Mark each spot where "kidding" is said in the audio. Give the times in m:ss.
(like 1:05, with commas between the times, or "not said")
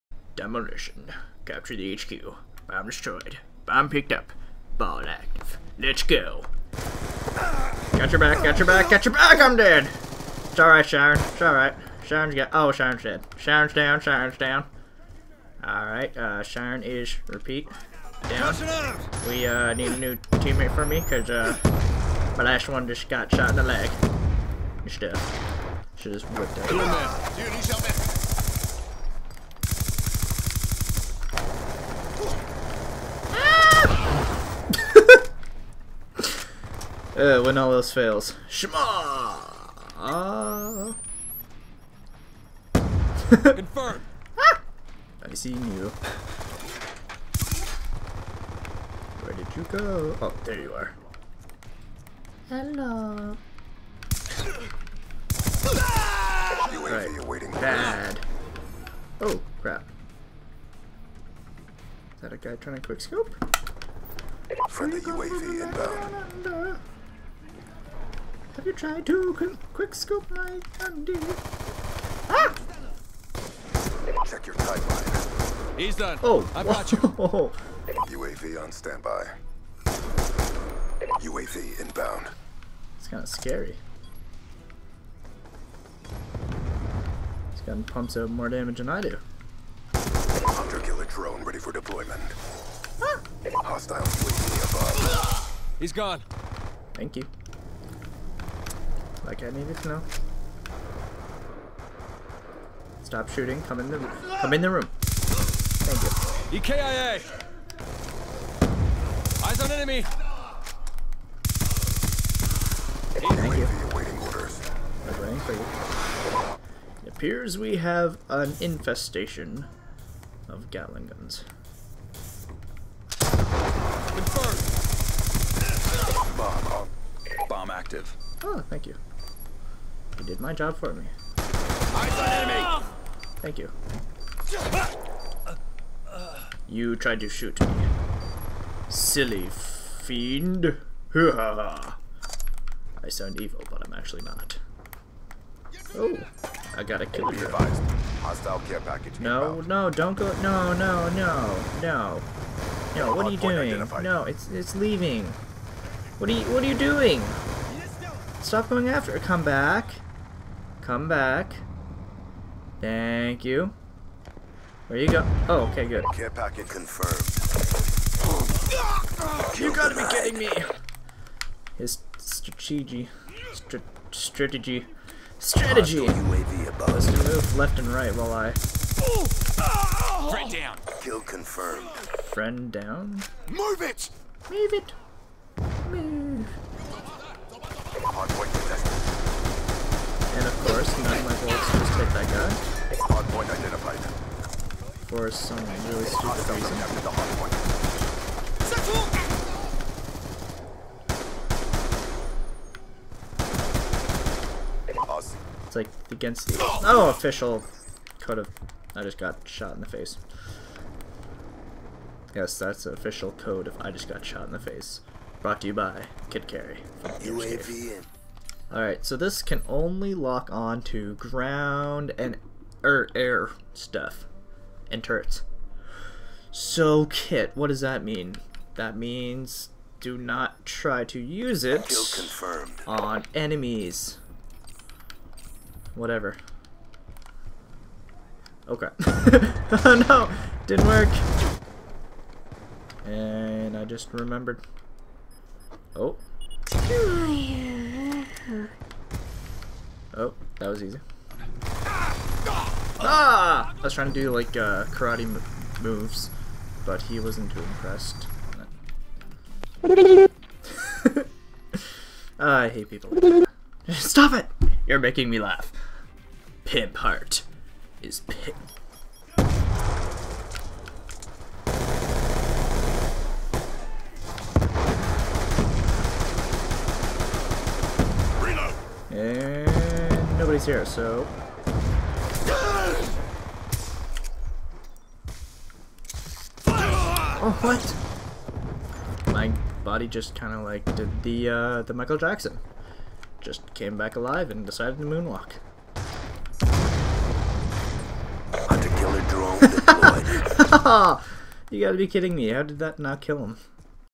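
2:50, 5:02.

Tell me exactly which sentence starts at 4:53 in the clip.
Just came back alive and decided to moonwalk.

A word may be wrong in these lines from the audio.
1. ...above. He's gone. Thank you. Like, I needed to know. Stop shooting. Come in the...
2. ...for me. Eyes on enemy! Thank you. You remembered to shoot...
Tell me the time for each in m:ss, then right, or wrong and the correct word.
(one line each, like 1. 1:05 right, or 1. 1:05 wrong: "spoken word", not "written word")
1. 1:35 right
2. 2:10 wrong: "tried", not "remembered".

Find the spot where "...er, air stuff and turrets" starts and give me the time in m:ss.
3:42.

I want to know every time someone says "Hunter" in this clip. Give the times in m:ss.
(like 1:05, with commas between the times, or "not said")
1:29, 4:58.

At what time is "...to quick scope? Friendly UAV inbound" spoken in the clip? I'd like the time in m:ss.
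1:02.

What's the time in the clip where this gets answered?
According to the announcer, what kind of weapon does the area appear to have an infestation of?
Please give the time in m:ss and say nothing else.
2:00.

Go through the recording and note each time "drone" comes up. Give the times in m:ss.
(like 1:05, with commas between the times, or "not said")
1:31, 4:59.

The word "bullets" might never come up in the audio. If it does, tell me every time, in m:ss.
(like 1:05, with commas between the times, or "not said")
3:11.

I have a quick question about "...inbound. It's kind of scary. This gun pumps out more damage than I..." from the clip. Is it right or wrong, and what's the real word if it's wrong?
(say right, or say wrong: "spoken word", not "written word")
right.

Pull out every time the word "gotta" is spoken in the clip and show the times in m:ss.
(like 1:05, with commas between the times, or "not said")
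2:26, 2:49, 5:01.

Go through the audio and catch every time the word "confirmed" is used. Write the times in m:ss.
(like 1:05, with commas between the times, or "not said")
0:43, 2:03, 2:46, 3:01.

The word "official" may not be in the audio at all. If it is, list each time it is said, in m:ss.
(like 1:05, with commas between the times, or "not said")
3:27, 3:32.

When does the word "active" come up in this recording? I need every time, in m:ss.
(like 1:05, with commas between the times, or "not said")
0:05, 2:07.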